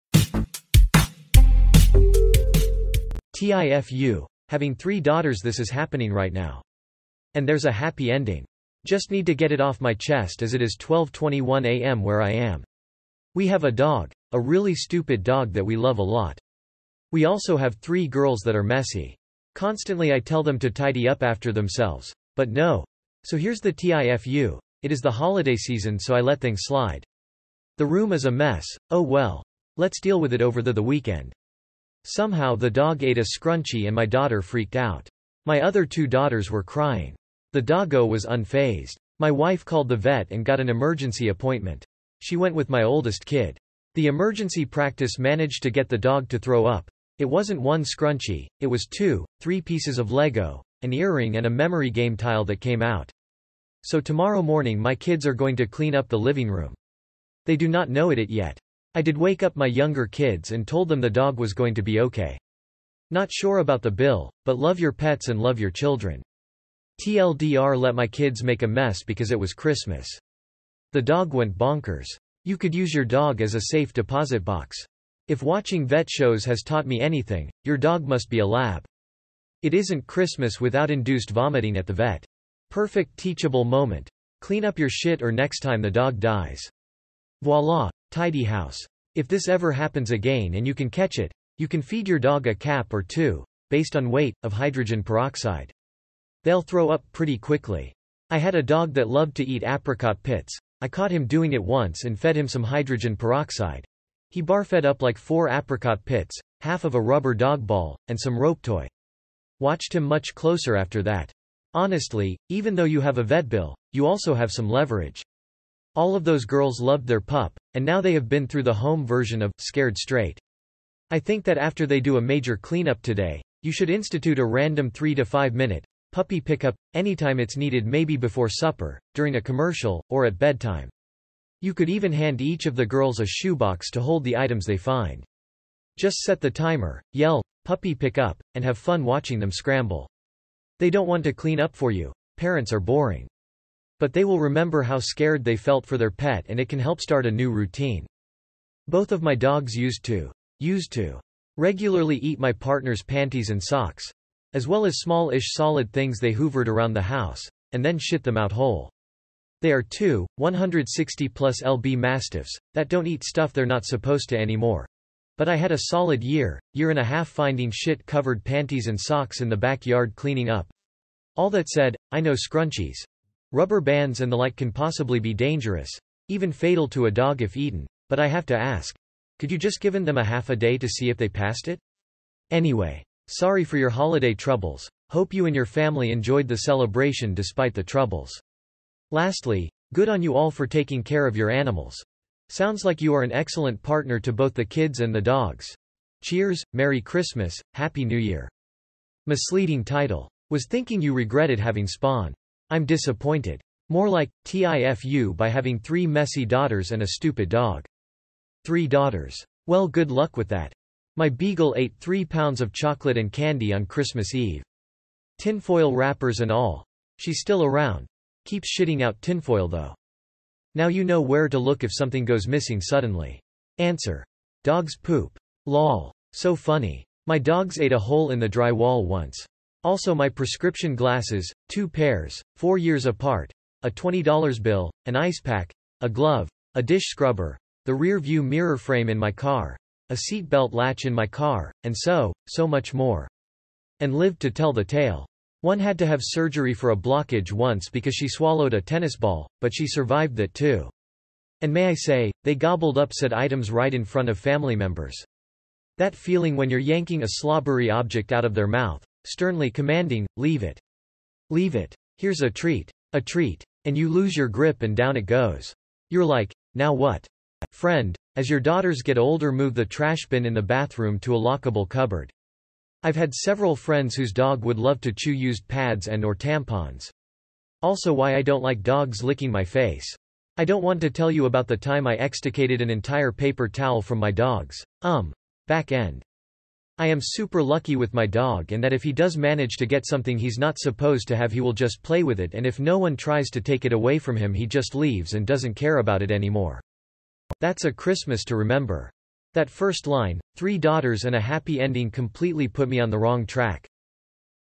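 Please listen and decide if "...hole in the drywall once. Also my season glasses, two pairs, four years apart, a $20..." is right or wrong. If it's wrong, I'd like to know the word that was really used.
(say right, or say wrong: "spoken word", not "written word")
wrong: "prescription", not "season".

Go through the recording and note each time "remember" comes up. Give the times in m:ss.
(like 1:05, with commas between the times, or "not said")
2:24, 4:58.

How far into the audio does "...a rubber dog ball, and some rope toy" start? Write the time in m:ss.
1:46.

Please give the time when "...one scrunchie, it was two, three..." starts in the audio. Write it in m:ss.
0:47.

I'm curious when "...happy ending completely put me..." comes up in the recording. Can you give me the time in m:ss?
5:01.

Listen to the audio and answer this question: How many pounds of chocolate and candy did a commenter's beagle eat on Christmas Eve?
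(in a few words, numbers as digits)
3.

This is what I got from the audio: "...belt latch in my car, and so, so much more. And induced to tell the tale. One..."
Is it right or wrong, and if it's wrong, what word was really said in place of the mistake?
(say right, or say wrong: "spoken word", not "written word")
wrong: "lived", not "induced".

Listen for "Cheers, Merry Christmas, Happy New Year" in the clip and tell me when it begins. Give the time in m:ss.
3:16.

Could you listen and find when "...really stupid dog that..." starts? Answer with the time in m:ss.
0:14.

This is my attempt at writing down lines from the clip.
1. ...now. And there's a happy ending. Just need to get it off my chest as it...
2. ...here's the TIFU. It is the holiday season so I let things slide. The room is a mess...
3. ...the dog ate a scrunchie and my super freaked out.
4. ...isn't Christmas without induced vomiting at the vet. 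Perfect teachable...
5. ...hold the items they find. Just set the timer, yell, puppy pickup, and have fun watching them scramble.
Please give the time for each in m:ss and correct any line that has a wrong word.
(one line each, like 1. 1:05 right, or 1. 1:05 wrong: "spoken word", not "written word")
1. 0:06 right
2. 0:23 right
3. 0:32 wrong: "daughter", not "super"
4. 1:19 right
5. 2:14 right.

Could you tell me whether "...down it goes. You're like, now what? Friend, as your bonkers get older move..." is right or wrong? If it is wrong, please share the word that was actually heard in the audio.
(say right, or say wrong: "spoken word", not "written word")
wrong: "daughters", not "bonkers".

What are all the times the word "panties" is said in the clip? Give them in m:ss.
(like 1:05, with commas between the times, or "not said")
2:33, 2:48.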